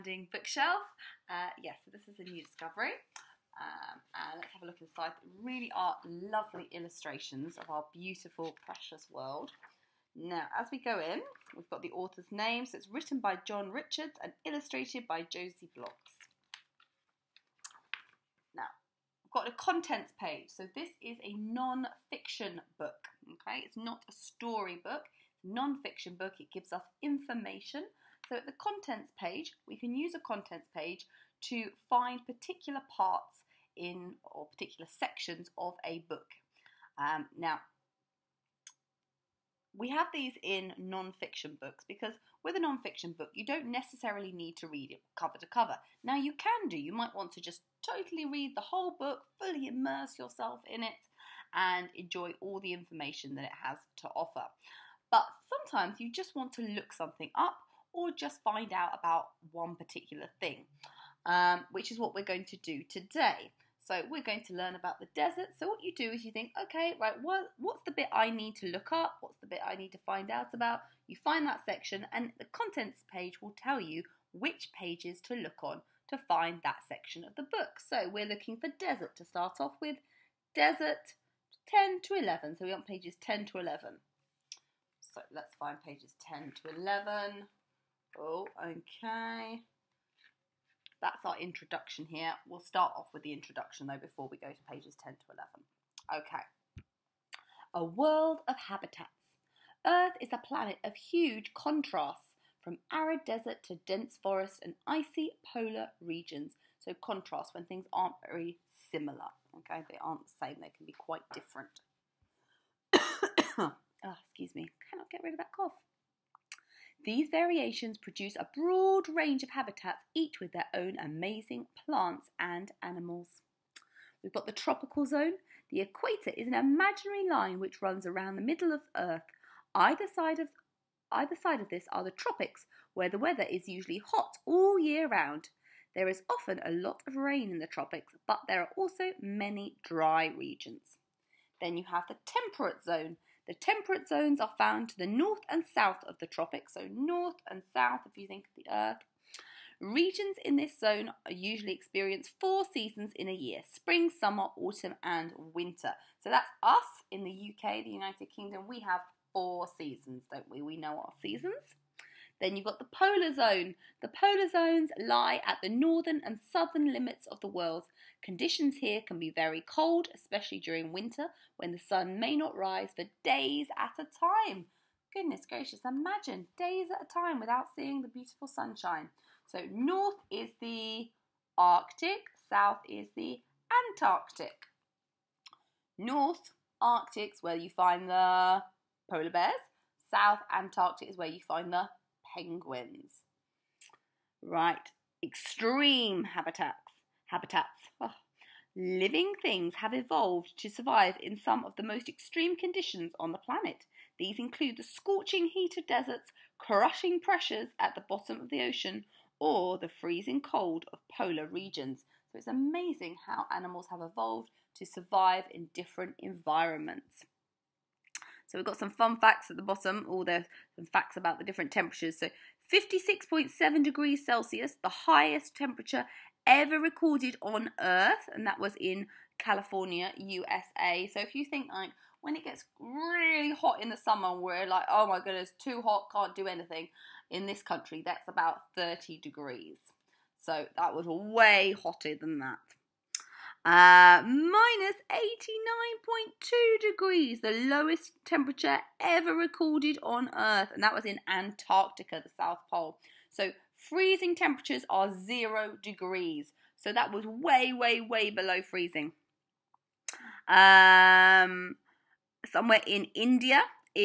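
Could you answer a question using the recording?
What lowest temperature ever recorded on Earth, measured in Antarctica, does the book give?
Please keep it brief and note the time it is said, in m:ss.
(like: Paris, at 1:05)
-89.2 degrees, at 4:04.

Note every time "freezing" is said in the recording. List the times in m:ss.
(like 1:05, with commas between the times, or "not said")
3:29, 4:13, 4:18.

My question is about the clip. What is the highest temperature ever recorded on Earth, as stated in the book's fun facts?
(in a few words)
56.7 degrees Celsius.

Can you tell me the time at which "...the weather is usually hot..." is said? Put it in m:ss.
2:13.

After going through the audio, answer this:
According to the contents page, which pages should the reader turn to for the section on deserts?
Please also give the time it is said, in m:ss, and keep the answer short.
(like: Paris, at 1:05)
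10 to 11, at 1:20.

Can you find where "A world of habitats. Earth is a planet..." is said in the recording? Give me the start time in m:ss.
1:37.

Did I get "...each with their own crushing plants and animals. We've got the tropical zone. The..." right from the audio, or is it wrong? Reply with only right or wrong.
wrong.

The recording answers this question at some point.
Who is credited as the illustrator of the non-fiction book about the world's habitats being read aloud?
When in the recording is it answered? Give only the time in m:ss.
0:15.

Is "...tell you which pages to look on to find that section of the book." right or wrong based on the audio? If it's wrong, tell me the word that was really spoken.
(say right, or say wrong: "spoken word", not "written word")
right.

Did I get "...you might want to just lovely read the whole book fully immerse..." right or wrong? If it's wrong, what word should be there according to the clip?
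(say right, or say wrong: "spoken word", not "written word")
wrong: "totally", not "lovely".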